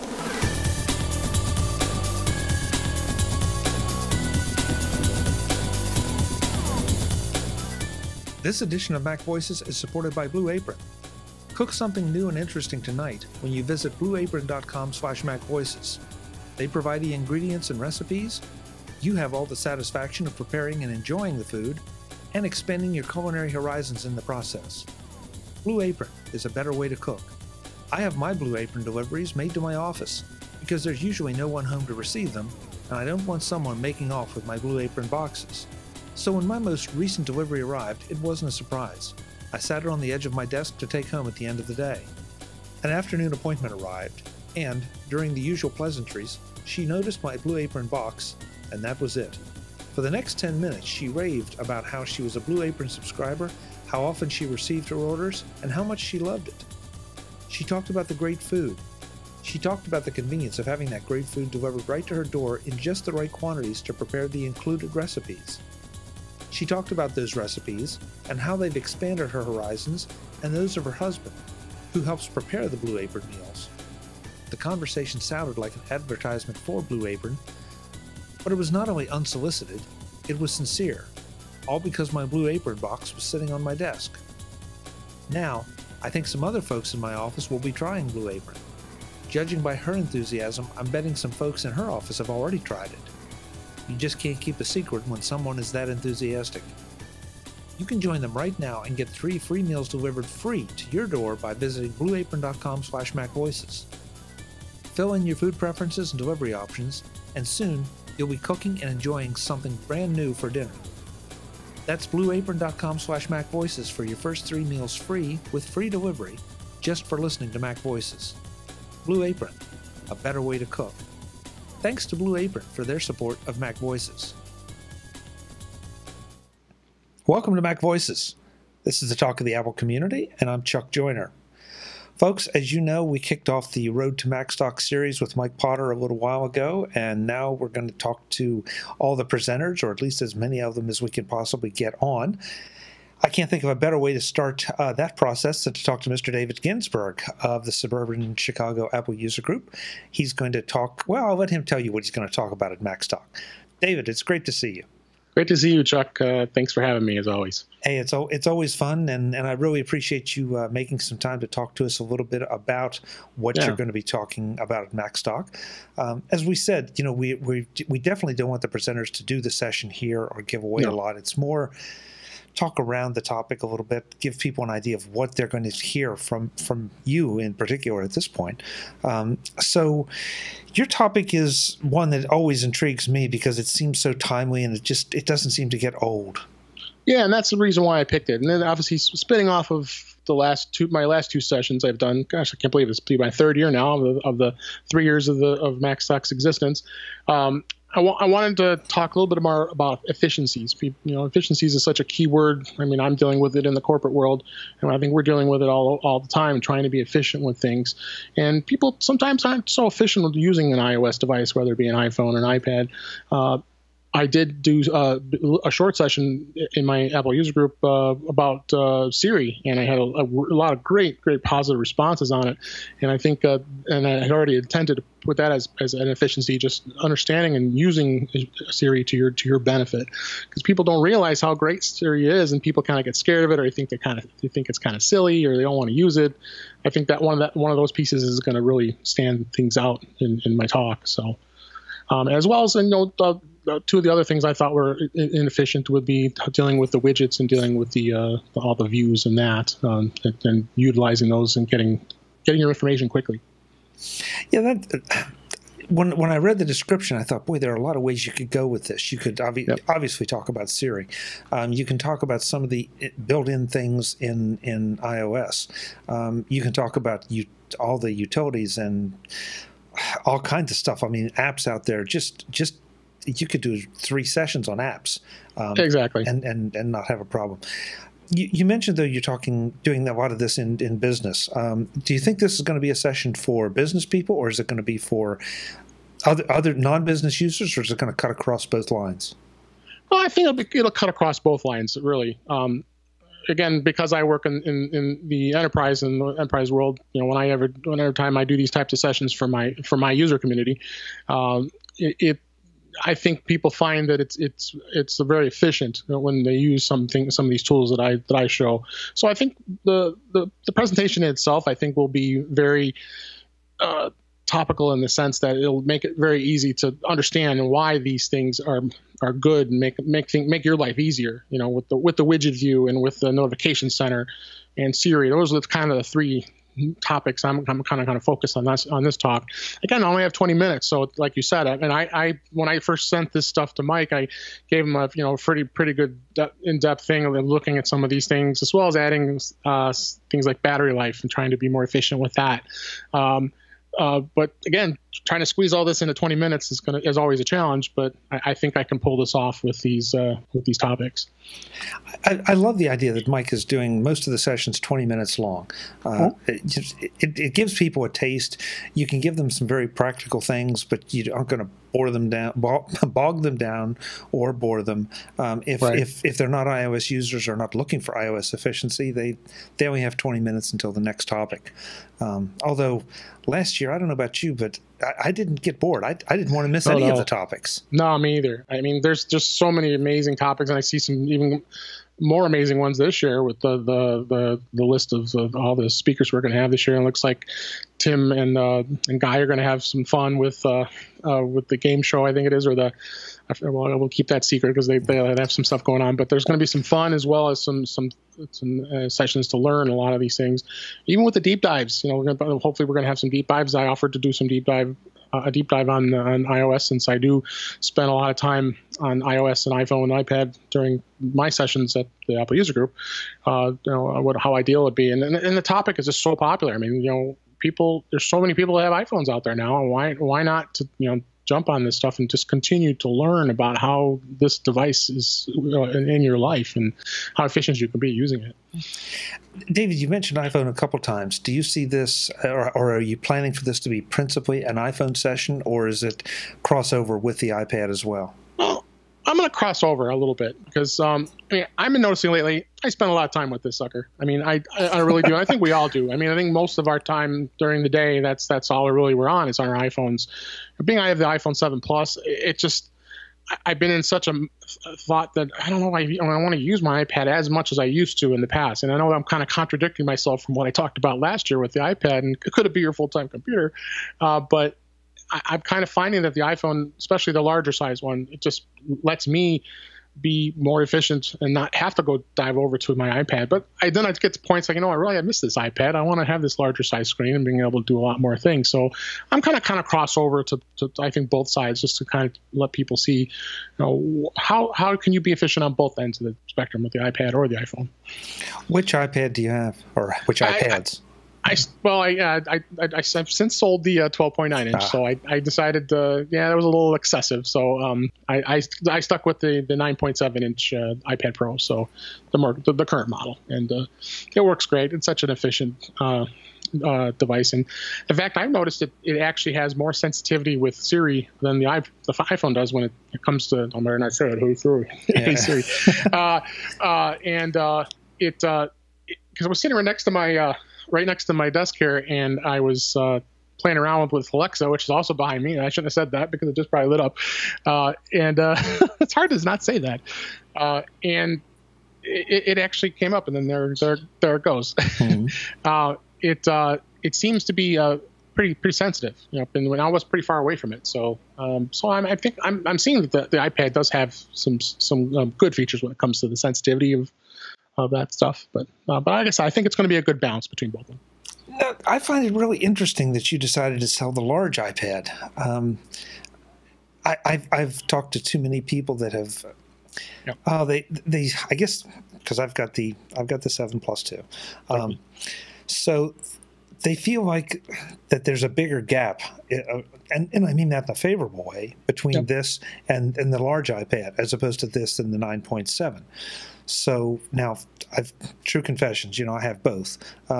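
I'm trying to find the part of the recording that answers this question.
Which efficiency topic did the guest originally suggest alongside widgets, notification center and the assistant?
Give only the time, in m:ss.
5:40.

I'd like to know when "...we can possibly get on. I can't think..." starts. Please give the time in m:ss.
2:21.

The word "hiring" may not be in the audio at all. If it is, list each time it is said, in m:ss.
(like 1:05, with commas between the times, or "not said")
not said.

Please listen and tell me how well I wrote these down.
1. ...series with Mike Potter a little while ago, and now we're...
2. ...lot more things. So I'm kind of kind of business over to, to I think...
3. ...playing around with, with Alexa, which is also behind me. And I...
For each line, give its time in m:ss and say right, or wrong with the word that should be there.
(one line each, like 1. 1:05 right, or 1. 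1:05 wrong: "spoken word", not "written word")
1. 2:14 right
2. 7:58 wrong: "cross", not "business"
3. 8:43 right.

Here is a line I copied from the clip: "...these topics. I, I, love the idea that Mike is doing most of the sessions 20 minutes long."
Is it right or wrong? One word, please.
right.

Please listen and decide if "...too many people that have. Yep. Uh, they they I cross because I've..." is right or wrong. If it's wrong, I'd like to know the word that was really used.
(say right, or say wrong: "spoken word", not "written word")
wrong: "guess", not "cross".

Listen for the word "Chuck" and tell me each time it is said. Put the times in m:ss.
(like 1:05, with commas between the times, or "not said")
2:10, 2:35.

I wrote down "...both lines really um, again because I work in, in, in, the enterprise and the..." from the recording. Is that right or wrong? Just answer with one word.
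right.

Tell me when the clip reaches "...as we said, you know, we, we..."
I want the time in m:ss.
2:46.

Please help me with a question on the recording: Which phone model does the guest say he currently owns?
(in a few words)
iPhone 7 Plus.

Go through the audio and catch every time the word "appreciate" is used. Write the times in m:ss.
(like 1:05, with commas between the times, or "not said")
2:39.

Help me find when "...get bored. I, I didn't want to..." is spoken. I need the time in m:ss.
6:15.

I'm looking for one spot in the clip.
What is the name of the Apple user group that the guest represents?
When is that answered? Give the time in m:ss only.
2:27.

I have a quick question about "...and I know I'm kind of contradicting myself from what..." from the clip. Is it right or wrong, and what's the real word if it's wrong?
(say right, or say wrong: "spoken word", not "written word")
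right.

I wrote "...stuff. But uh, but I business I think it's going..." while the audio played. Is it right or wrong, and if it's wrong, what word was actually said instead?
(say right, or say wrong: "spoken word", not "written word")
wrong: "guess", not "business".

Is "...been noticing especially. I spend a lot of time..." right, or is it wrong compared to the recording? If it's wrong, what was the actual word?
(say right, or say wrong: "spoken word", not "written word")
wrong: "lately", not "especially".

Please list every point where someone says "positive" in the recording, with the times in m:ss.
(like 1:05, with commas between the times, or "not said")
3:41.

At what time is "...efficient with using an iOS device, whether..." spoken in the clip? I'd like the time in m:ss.
3:29.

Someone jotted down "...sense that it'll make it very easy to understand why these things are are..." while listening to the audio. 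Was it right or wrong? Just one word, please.
right.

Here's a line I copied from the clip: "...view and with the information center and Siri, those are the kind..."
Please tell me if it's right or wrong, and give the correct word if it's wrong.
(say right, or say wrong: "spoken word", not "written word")
wrong: "notification", not "information".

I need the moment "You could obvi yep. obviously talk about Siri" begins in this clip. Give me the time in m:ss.
4:19.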